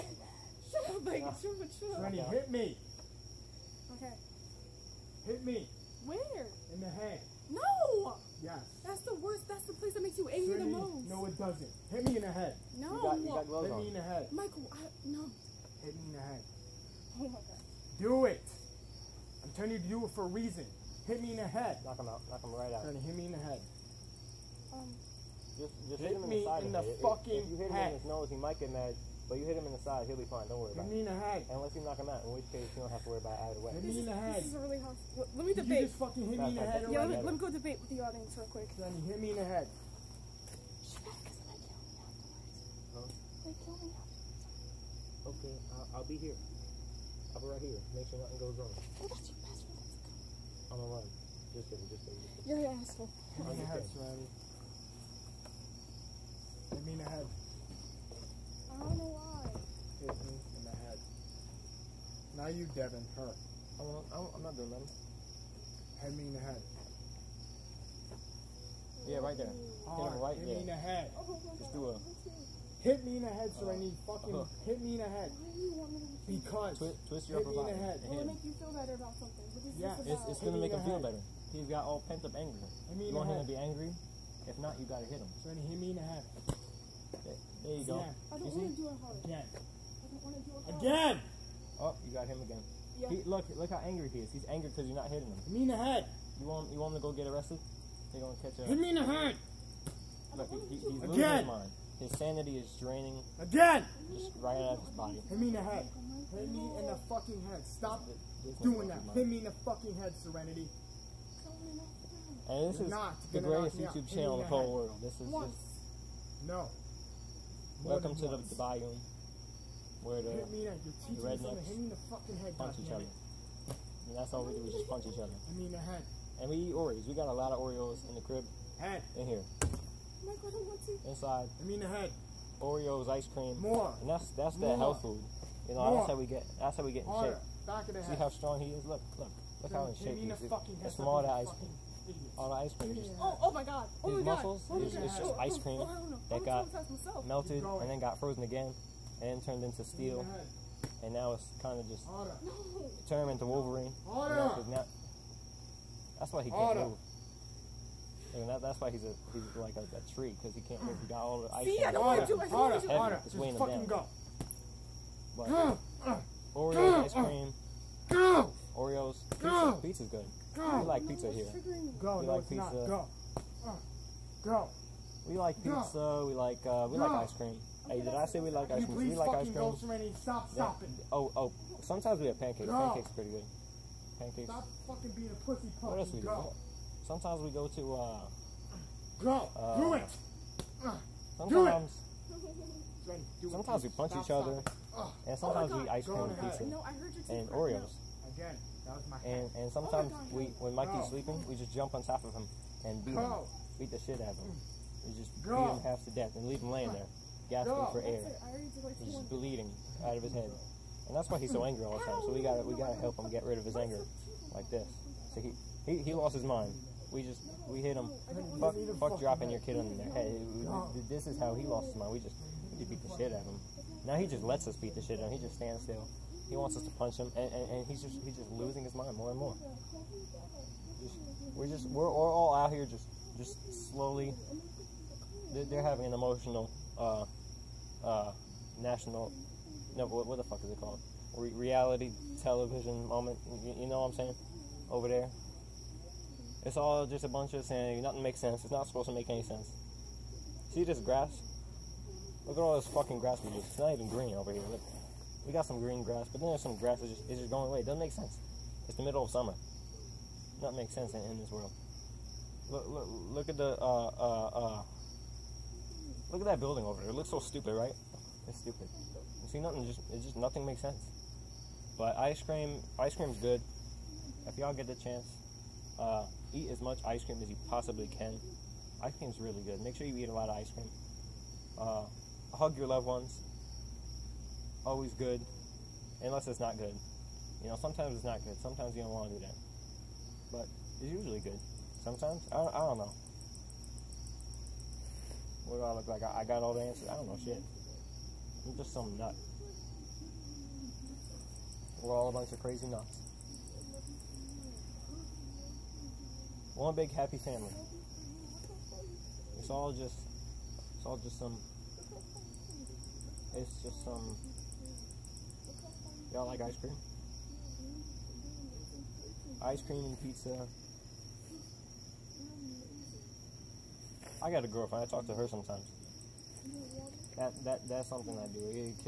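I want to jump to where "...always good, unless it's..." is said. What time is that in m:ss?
4:44.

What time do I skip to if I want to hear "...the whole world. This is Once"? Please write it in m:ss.
1:54.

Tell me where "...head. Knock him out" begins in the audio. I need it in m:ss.
0:21.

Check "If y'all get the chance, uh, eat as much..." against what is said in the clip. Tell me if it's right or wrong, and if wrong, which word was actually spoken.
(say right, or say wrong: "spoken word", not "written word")
right.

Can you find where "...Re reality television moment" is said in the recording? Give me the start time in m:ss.
4:01.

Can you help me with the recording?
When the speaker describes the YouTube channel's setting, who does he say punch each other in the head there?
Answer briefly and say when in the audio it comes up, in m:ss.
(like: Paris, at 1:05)
rednecks, at 2:01.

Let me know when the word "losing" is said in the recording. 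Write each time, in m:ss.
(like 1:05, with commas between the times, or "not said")
1:41, 3:48.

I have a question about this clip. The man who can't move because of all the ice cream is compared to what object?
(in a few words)
a tree.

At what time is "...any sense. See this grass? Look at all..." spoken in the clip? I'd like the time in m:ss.
4:09.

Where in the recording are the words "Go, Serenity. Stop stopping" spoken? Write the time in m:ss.
2:59.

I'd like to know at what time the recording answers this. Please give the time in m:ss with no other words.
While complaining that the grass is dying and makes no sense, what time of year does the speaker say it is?
4:19.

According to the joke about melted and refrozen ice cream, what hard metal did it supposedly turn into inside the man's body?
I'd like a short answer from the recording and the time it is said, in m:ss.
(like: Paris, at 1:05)
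steel, at 2:29.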